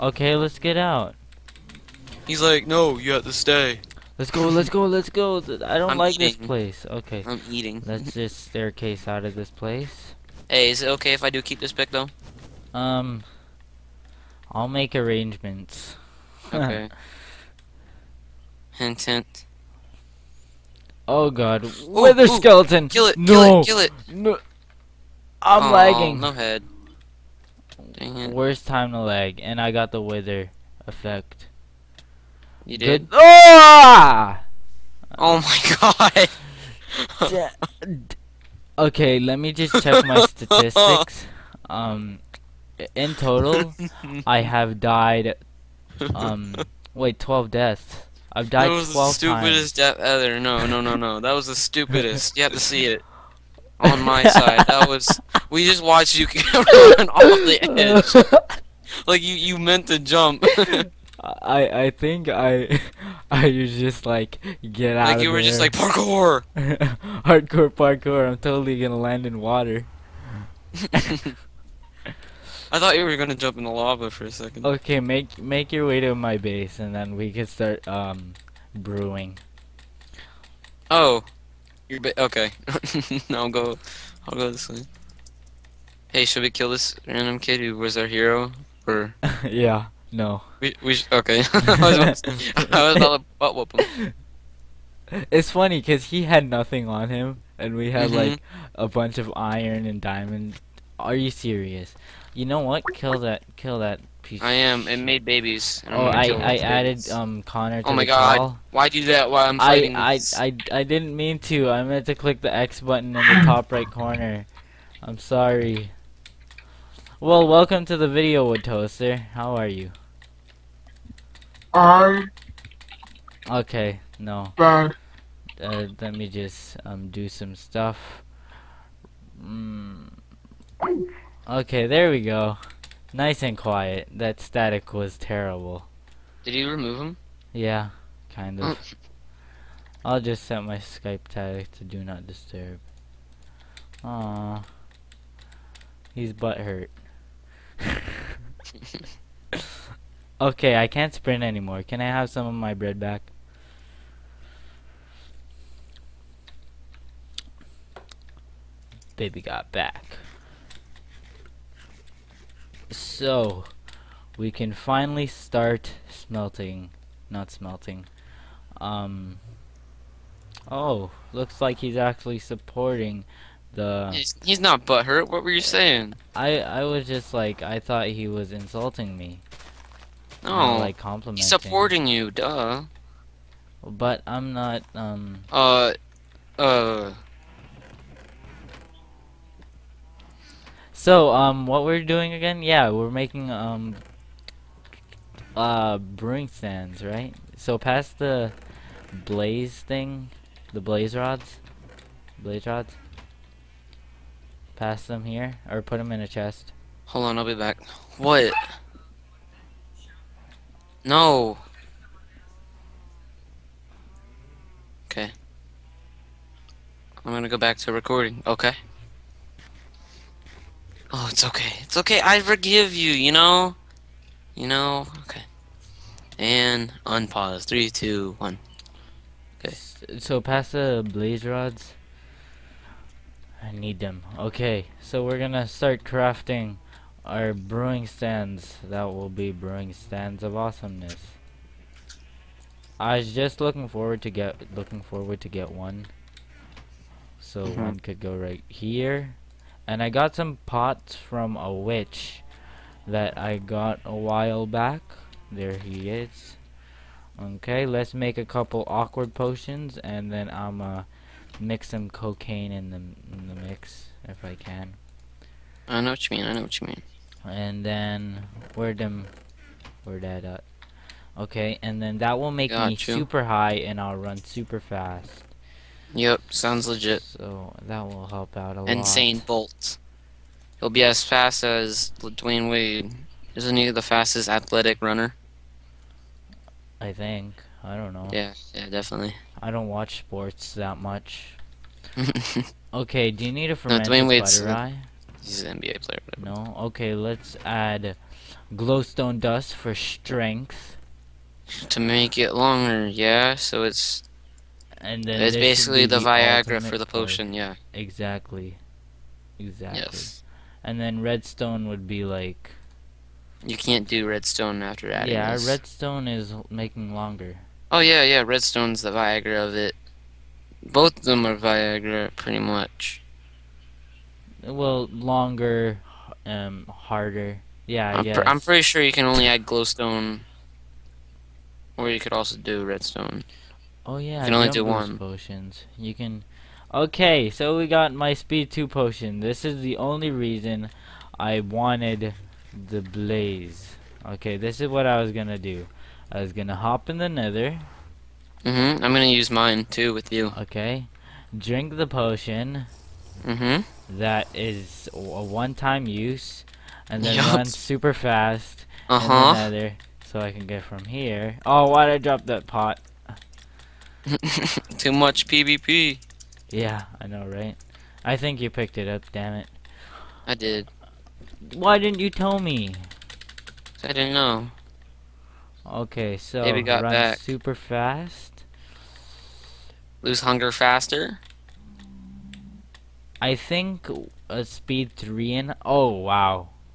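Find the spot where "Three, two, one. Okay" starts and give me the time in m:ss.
3:47.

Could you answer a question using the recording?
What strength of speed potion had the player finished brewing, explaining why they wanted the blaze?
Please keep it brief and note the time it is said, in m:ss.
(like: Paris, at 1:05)
Speed 2, at 5:38.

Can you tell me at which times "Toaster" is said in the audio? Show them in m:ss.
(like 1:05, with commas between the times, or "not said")
1:58.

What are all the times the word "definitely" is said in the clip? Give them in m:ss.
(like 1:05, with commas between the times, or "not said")
4:48.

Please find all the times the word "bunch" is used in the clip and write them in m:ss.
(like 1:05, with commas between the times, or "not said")
1:38.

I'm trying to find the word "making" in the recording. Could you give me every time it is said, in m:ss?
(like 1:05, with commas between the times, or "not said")
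3:13, 5:16.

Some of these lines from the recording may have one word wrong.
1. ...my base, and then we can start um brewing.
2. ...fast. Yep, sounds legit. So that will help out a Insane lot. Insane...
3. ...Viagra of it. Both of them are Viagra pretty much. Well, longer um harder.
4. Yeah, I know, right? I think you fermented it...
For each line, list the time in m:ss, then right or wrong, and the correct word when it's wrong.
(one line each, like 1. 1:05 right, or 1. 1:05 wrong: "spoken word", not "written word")
1. 1:16 right
2. 4:34 right
3. 5:19 right
4. 6:06 wrong: "picked", not "fermented".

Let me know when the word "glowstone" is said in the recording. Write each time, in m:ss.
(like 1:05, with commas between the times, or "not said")
4:58, 5:29.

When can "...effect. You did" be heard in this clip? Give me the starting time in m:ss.
0:30.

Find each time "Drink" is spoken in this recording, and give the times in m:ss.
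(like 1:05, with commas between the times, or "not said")
5:51.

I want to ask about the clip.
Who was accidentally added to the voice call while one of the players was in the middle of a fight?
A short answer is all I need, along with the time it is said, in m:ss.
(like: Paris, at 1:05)
Connor, at 1:47.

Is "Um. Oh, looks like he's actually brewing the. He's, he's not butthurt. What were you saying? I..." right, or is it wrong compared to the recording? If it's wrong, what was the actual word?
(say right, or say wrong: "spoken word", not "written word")
wrong: "supporting", not "brewing".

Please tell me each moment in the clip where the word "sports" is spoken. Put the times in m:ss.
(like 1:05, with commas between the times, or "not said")
4:50.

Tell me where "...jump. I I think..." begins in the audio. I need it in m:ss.
0:59.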